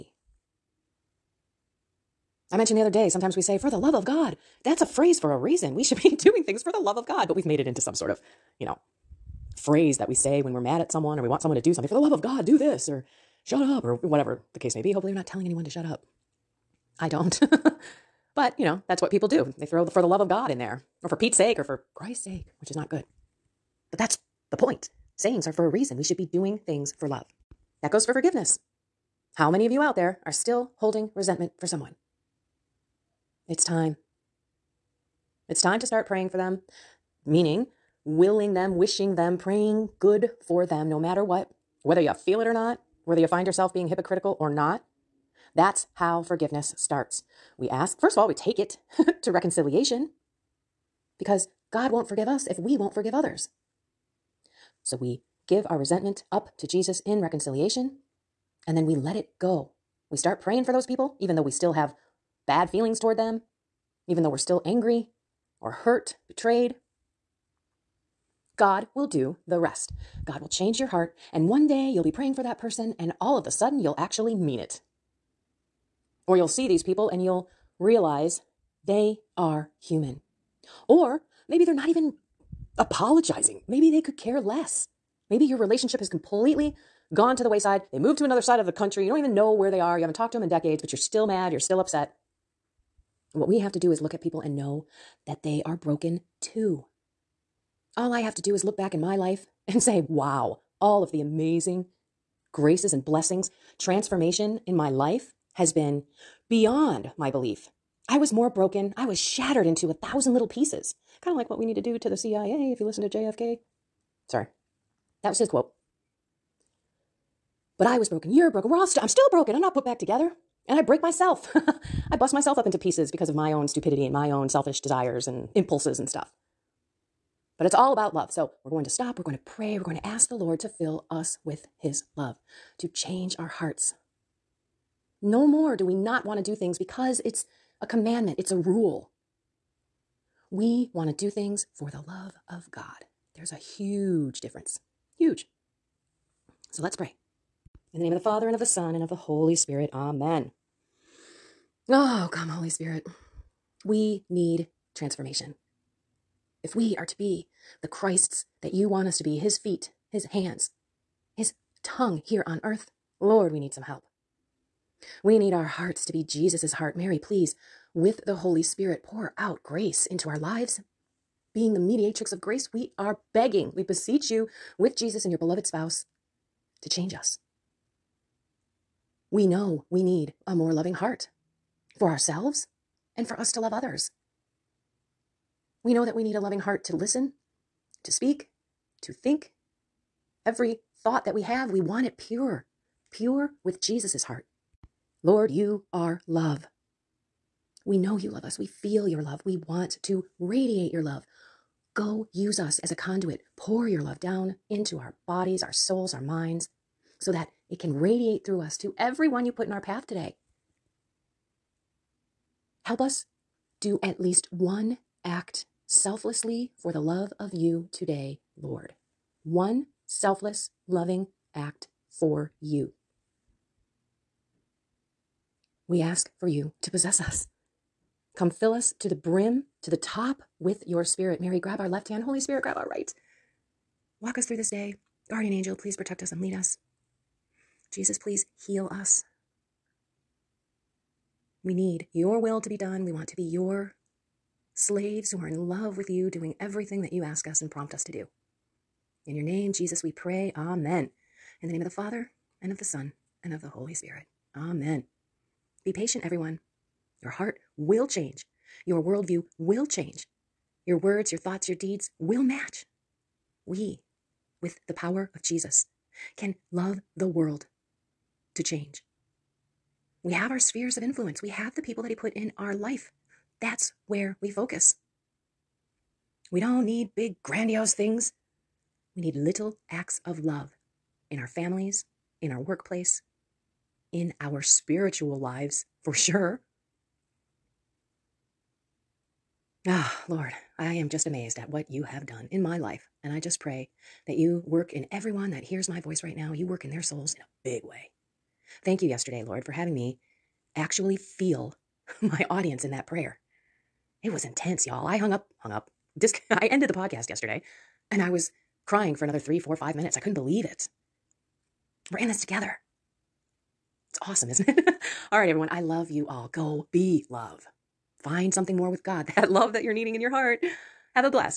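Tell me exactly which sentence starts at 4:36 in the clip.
We don't need big, grandiose things.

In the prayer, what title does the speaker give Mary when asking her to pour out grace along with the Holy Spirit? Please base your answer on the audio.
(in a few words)
Mediatrix of grace.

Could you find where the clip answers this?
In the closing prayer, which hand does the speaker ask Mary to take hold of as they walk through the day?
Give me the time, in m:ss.
3:51.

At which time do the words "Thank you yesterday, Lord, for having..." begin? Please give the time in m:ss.
4:58.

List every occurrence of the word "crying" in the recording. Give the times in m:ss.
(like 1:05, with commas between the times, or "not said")
5:08.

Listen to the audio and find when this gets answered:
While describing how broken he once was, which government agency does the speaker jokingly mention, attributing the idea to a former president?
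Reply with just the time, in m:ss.
1:52.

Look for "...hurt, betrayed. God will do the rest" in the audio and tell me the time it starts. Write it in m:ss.
1:05.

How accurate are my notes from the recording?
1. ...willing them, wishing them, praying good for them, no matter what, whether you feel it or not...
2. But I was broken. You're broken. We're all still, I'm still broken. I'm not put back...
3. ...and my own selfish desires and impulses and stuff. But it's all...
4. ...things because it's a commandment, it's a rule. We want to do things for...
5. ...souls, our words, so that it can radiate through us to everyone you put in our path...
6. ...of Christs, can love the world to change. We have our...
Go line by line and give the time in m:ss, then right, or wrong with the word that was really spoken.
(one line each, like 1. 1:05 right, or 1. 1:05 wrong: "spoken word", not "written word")
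1. 0:38 right
2. 1:57 right
3. 2:04 right
4. 2:16 right
5. 3:25 wrong: "minds", not "words"
6. 4:25 wrong: "Jesus", not "Christs".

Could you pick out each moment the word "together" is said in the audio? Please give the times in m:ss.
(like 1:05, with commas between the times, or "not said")
1:59, 5:12.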